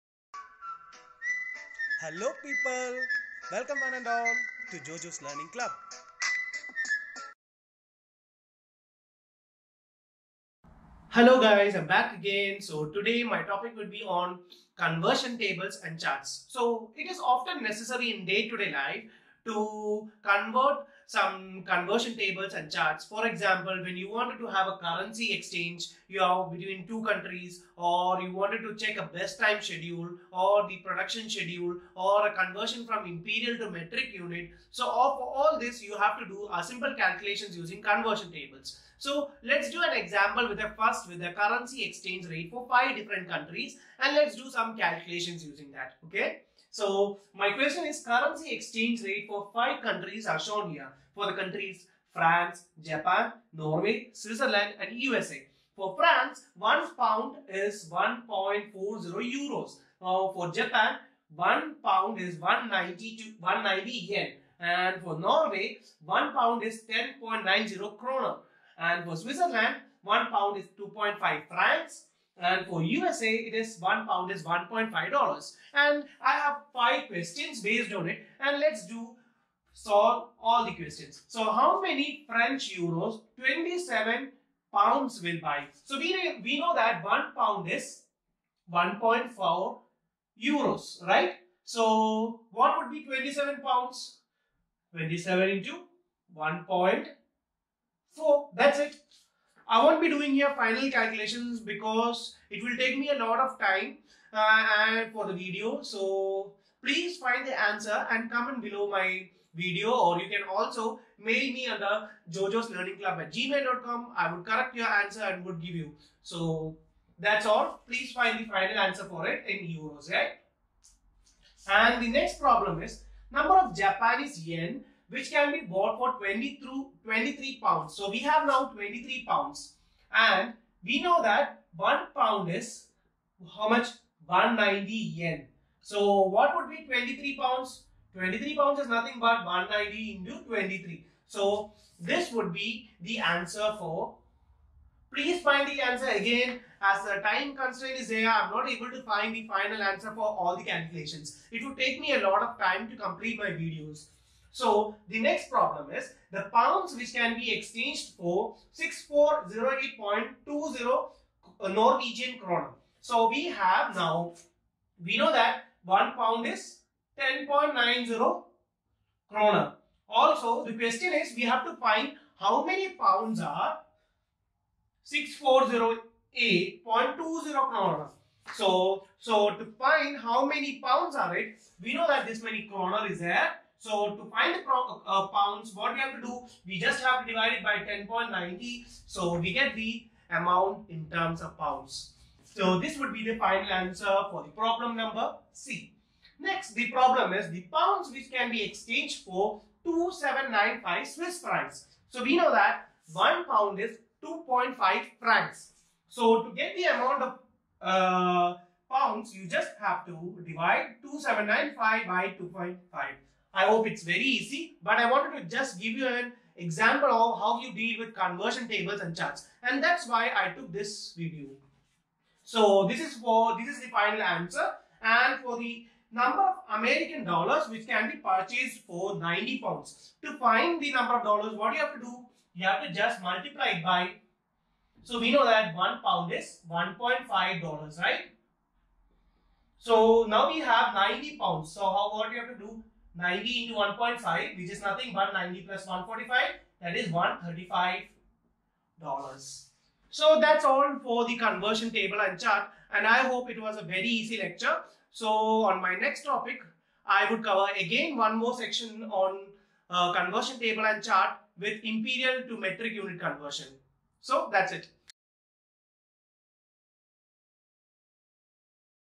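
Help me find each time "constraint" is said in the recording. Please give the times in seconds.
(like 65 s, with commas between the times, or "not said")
147 s.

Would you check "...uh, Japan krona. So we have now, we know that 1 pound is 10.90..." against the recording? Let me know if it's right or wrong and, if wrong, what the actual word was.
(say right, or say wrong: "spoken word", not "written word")
wrong: "Norwegian", not "Japan".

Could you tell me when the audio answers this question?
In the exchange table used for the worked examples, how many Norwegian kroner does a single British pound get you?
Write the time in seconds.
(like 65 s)
66 s.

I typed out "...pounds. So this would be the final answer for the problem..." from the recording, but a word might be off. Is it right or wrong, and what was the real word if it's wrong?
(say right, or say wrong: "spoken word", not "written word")
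right.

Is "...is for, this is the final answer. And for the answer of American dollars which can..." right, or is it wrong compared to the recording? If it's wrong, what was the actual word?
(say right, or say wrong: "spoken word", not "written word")
wrong: "number", not "answer".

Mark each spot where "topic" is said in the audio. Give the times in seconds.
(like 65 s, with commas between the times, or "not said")
13 s, 256 s.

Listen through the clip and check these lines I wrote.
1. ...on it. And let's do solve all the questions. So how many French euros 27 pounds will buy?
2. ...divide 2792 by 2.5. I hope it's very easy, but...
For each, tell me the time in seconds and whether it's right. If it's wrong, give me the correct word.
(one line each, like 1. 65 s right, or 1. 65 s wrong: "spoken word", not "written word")
1. 77 s right
2. 210 s wrong: "2795", not "2792".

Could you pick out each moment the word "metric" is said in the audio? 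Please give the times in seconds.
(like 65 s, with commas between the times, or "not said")
33 s, 262 s.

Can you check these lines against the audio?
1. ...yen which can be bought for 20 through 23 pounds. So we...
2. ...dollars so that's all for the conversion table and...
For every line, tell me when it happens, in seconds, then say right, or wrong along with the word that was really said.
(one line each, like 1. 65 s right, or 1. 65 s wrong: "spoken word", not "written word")
1. 124 s right
2. 249 s right.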